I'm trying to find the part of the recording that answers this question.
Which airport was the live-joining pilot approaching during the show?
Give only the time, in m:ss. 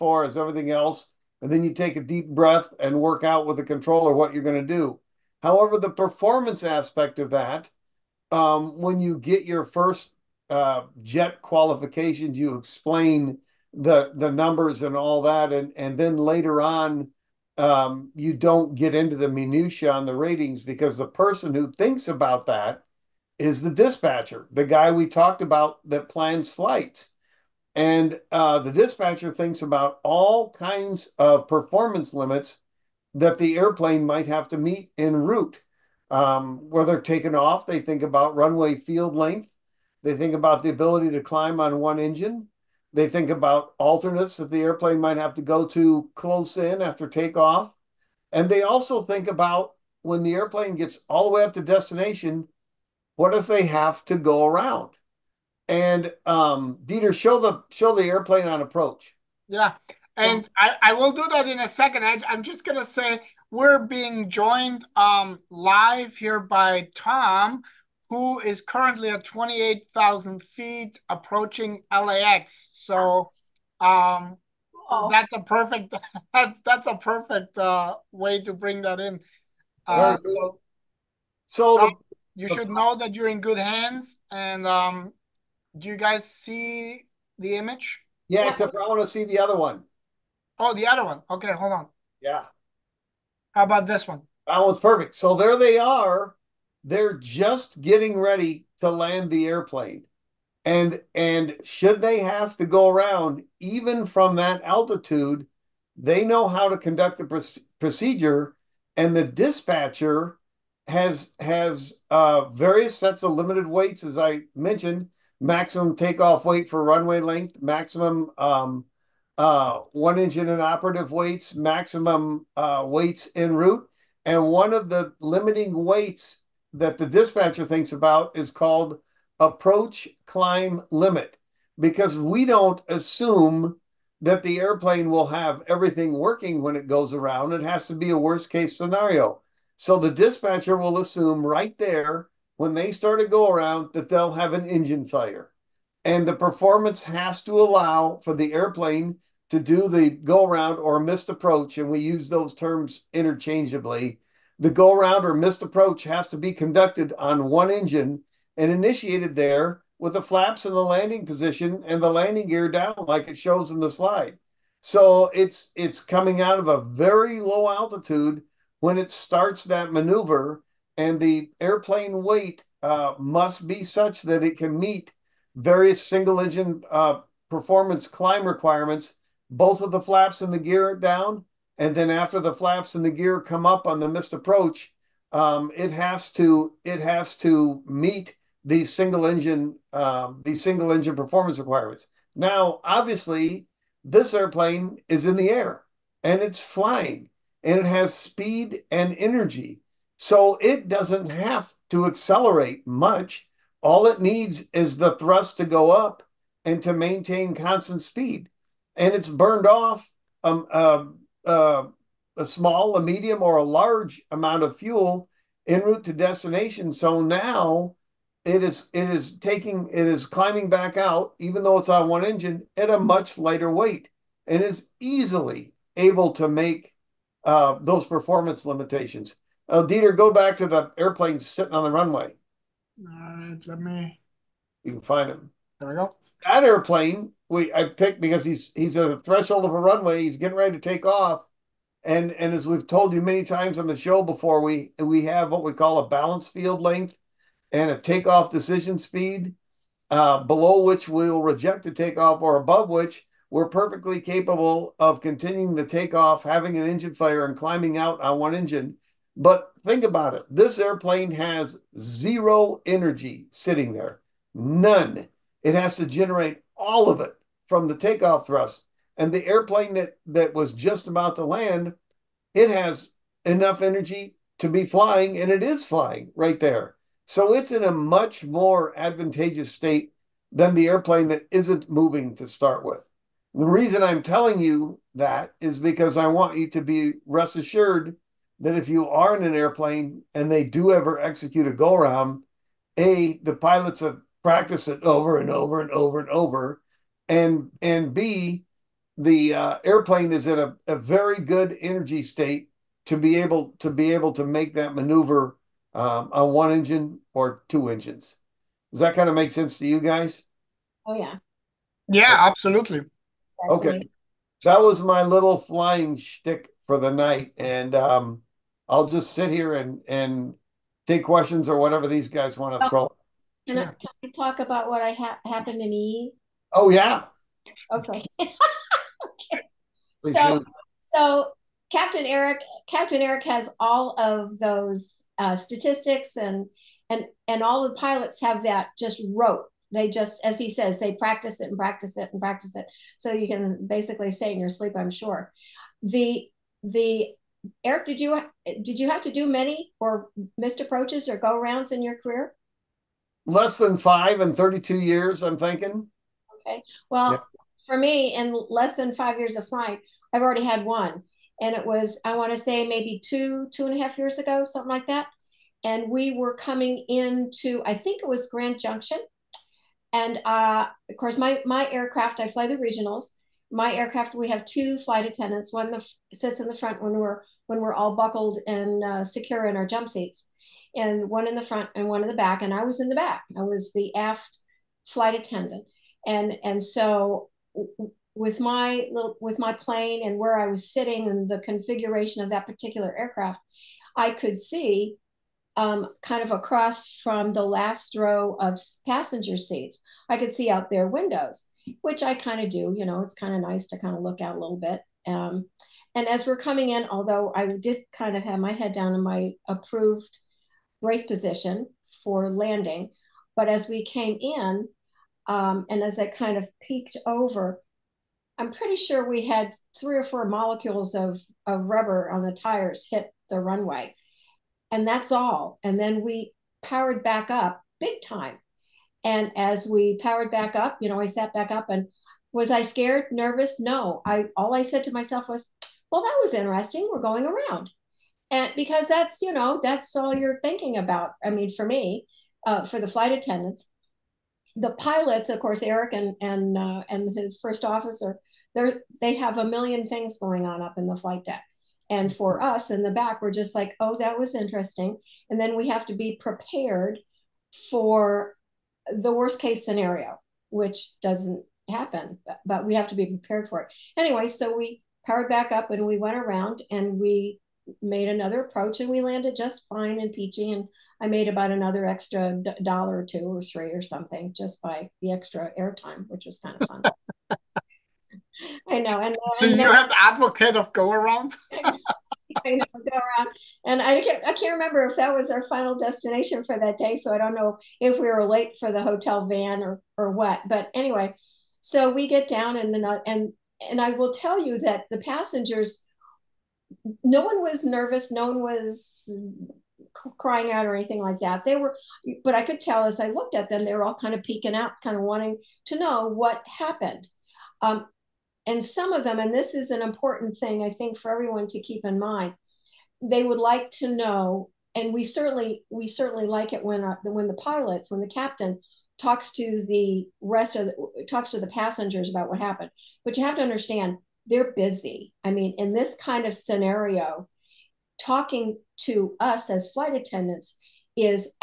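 1:11.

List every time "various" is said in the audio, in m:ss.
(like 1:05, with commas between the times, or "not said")
1:52, 2:55.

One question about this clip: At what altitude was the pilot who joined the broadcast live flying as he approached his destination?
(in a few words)
28,000 feet.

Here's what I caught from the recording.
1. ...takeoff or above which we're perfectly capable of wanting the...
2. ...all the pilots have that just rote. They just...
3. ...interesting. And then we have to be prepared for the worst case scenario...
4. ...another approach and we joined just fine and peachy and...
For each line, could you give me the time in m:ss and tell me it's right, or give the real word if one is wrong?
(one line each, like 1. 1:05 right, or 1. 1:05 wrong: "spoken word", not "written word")
1. 4:11 wrong: "continuing", not "wanting"
2. 5:37 right
3. 7:34 right
4. 7:48 wrong: "landed", not "joined".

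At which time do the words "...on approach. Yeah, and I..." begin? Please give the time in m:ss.
0:58.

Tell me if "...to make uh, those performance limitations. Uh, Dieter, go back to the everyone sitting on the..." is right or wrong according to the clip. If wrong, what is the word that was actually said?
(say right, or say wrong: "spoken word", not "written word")
wrong: "airplane", not "everyone".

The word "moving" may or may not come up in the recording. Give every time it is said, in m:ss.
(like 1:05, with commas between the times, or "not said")
4:41.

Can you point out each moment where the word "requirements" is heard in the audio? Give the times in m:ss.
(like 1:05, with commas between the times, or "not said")
2:58, 3:11.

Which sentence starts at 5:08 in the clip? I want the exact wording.
Does that kind of make sense to you guys?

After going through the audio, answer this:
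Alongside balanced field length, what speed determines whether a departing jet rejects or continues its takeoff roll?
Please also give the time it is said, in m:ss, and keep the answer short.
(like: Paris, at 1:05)
Takeoff decision speed, at 4:07.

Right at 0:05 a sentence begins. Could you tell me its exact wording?
However, the performance aspect of that, um, when you get your first uh, jet qualifications.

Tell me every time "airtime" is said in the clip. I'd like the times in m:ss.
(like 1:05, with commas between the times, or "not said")
7:55.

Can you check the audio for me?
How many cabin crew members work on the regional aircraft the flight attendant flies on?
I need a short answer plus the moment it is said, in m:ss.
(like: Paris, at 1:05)
2, at 6:14.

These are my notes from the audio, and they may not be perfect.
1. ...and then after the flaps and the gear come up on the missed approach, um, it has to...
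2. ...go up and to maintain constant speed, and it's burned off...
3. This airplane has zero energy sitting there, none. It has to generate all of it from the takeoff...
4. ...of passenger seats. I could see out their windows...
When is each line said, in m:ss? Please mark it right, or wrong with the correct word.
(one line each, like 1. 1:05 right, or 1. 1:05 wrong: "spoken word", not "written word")
1. 3:01 right
2. 3:25 right
3. 4:20 right
4. 6:38 right.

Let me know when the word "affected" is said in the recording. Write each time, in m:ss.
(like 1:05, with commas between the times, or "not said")
not said.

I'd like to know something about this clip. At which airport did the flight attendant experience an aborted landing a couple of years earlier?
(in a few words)
Grand Junction.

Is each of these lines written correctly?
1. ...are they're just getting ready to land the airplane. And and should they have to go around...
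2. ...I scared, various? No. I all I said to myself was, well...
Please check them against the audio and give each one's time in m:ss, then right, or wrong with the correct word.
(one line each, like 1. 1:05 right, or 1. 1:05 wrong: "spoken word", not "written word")
1. 1:35 right
2. 7:12 wrong: "nervous", not "various".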